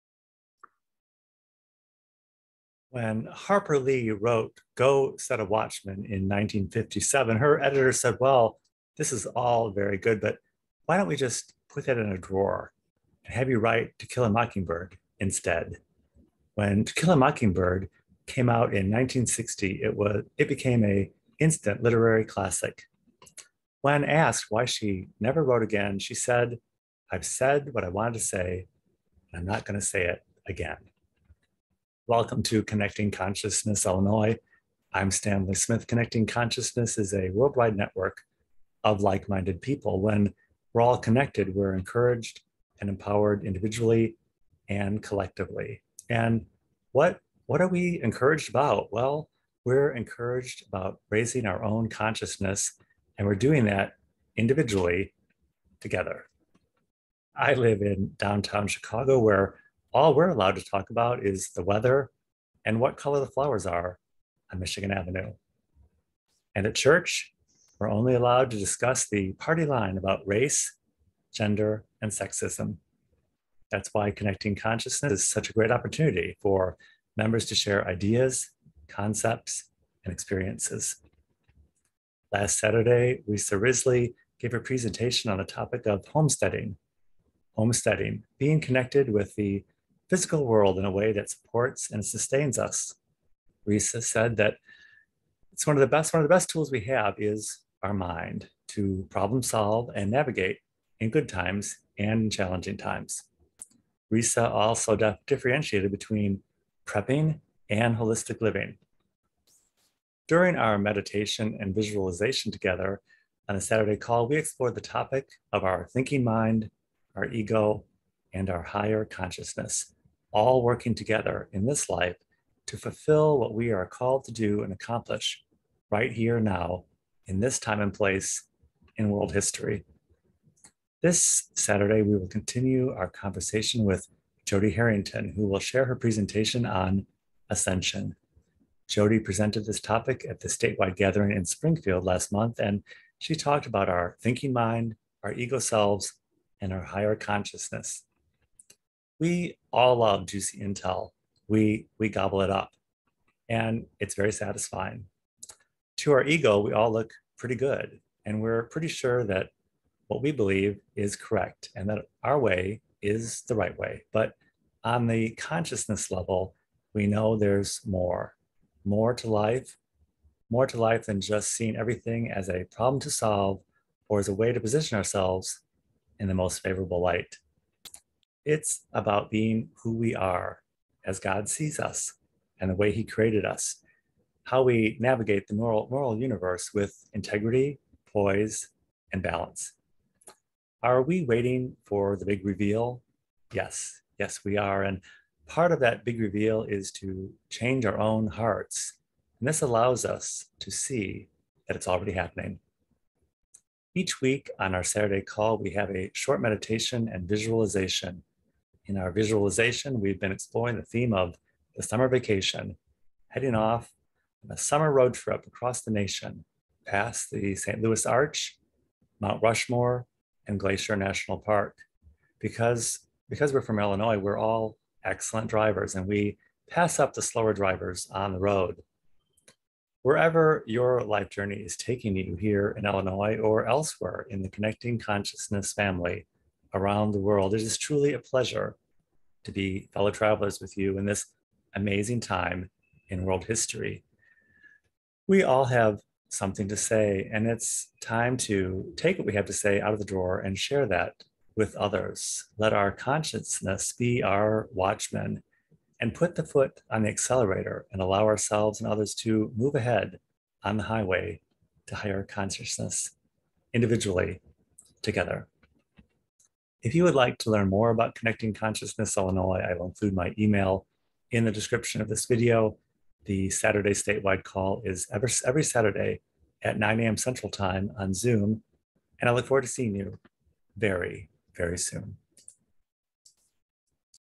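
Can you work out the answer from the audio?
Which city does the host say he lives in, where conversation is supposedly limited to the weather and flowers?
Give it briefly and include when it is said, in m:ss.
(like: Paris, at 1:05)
Chicago, at 0:58.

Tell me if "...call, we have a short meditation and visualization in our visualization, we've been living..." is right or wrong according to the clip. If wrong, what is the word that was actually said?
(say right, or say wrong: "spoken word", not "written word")
wrong: "exploring", not "living".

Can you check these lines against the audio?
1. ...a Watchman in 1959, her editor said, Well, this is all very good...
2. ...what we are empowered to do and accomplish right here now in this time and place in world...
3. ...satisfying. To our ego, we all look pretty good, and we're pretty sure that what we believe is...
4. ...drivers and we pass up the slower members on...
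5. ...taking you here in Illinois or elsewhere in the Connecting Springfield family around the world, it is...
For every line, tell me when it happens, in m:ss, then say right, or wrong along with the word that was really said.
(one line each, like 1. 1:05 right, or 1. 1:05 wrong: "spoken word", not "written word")
1. 0:05 wrong: "1957", not "1959"
2. 2:03 wrong: "called", not "empowered"
3. 2:34 right
4. 3:45 wrong: "drivers", not "members"
5. 3:51 wrong: "Consciousness", not "Springfield".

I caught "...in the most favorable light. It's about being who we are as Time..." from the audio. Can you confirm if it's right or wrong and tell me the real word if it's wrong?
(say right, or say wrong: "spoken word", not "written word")
wrong: "God", not "Time".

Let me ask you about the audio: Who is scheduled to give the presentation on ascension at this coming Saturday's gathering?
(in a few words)
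Jody Harrington.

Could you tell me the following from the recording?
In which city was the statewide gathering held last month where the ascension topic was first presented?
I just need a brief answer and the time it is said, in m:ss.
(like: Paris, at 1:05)
Springfield, at 2:21.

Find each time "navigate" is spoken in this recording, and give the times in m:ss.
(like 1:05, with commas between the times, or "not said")
1:40, 3:04.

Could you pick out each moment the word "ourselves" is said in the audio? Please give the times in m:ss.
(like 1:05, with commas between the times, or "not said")
2:54, 4:18.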